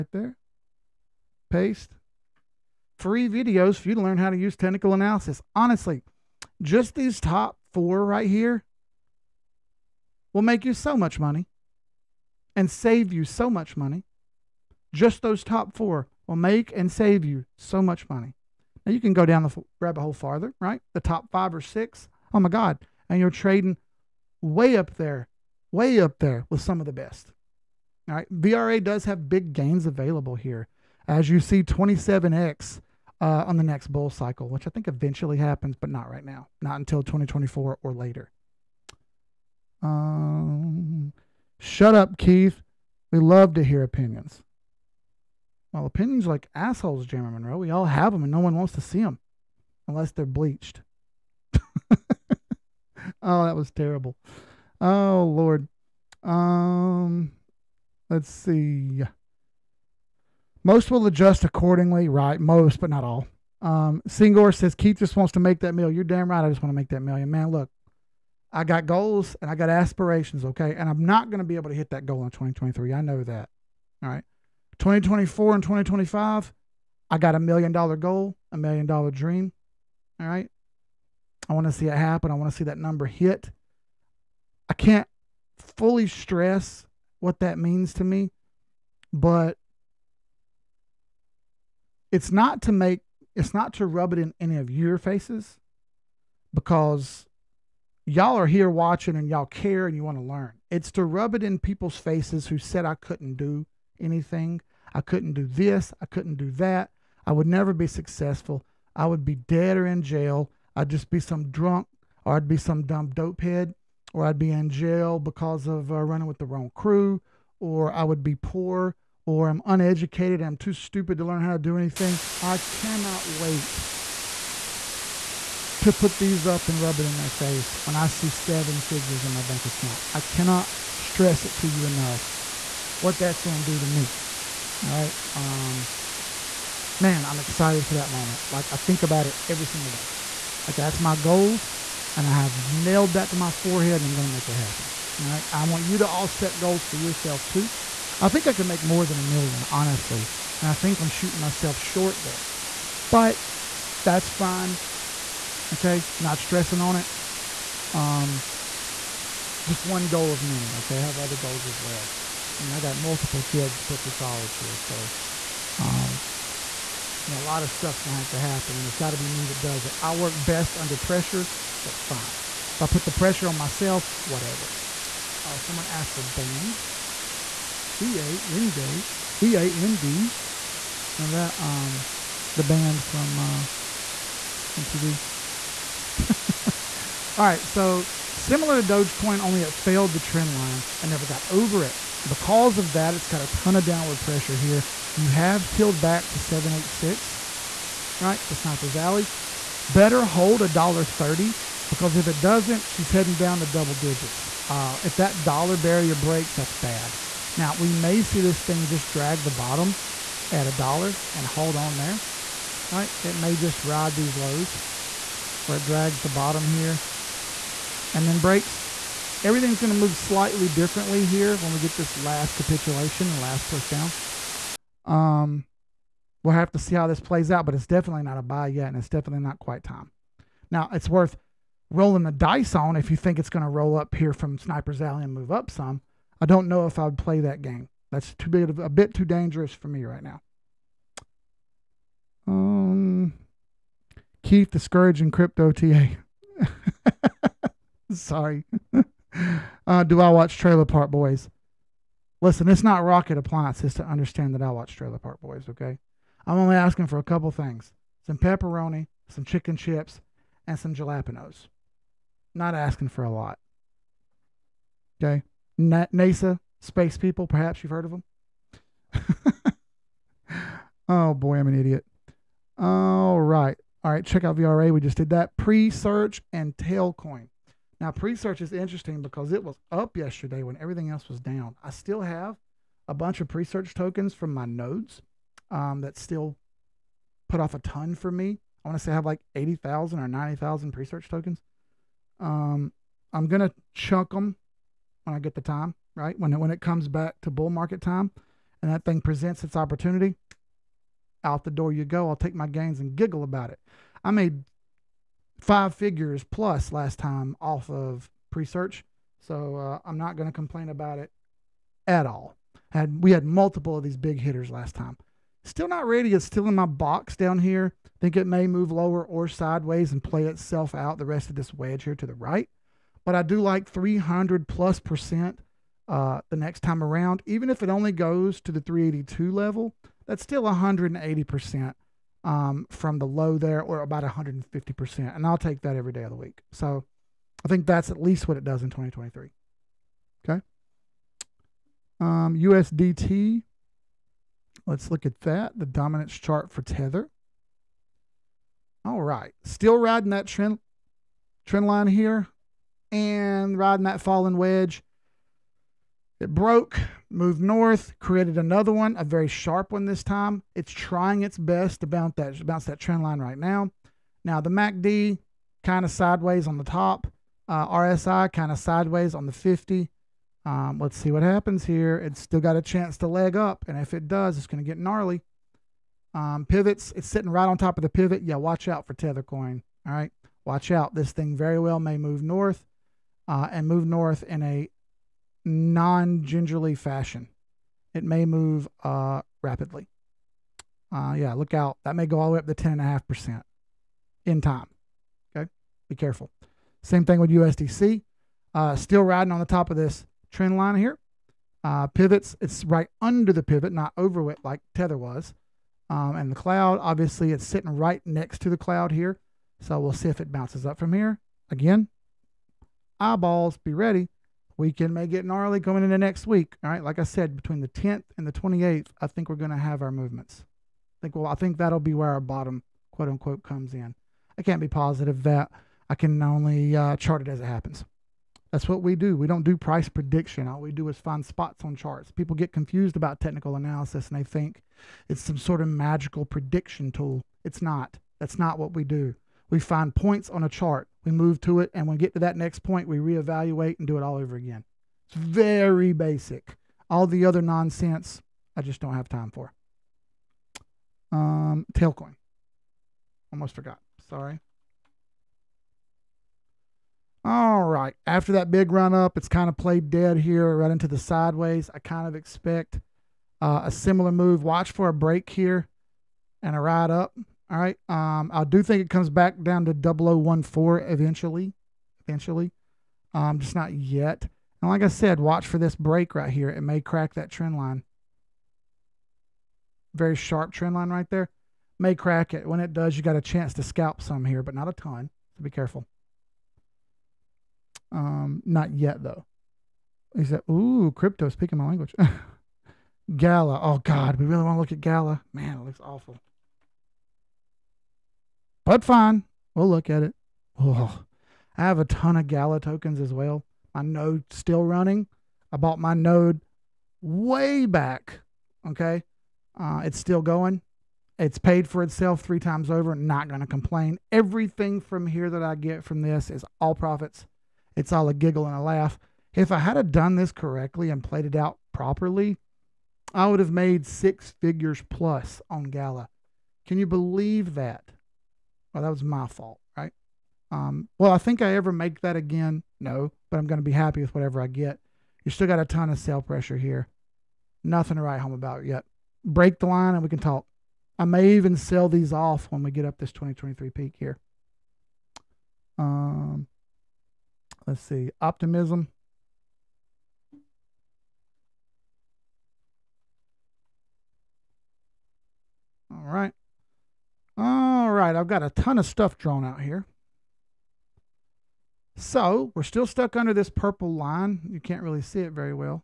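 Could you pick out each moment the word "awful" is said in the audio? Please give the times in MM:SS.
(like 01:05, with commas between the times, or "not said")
08:16.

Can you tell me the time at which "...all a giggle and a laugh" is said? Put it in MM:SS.
08:38.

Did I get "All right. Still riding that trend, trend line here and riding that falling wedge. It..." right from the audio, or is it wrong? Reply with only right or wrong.
right.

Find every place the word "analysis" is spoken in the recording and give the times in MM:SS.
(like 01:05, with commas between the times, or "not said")
00:04, 07:13.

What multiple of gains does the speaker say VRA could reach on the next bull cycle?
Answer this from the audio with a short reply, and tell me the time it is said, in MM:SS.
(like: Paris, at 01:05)
27X, at 00:31.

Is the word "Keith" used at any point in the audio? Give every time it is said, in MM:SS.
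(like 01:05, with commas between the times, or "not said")
00:42, 01:04, 04:04.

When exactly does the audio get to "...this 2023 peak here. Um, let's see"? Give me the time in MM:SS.
09:03.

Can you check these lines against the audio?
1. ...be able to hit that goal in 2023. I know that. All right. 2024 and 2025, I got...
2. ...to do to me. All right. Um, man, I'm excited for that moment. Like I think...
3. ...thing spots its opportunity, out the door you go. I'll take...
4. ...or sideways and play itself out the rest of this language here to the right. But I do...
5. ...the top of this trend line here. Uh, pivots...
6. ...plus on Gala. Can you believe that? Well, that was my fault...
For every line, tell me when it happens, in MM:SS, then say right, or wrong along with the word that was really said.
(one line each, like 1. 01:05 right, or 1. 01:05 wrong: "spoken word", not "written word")
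1. 01:11 right
2. 02:13 right
3. 04:59 wrong: "presents", not "spots"
4. 05:19 wrong: "wedge", not "language"
5. 06:39 right
6. 08:45 right.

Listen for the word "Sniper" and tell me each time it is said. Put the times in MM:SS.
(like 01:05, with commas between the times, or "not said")
03:18, 03:54.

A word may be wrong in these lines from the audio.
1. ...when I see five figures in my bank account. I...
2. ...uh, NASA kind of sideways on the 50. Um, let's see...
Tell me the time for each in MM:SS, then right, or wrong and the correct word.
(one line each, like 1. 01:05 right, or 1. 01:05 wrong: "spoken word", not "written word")
1. 02:07 wrong: "seven", not "five"
2. 06:07 wrong: "RSI", not "NASA".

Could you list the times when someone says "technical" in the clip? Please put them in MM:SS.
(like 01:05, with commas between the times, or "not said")
00:04, 07:13.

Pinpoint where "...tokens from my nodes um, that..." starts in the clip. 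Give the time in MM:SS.
04:43.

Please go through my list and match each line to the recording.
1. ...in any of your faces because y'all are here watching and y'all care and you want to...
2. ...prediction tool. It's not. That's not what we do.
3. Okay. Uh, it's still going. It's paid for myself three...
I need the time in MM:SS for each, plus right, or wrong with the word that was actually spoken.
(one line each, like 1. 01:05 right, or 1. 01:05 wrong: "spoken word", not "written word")
1. 01:34 right
2. 07:16 right
3. 08:28 wrong: "itself", not "myself".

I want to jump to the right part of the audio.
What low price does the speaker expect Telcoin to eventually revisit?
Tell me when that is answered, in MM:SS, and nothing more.
07:49.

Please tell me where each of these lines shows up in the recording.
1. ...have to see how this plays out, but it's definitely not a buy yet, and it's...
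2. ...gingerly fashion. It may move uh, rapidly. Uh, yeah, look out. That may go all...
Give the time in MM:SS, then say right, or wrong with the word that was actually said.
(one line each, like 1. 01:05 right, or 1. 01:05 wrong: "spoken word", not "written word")
1. 03:46 right
2. 06:26 right.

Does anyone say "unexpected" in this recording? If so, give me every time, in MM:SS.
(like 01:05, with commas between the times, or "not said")
not said.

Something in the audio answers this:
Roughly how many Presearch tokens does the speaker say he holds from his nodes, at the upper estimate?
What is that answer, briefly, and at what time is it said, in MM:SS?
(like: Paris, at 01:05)
90,000, at 04:50.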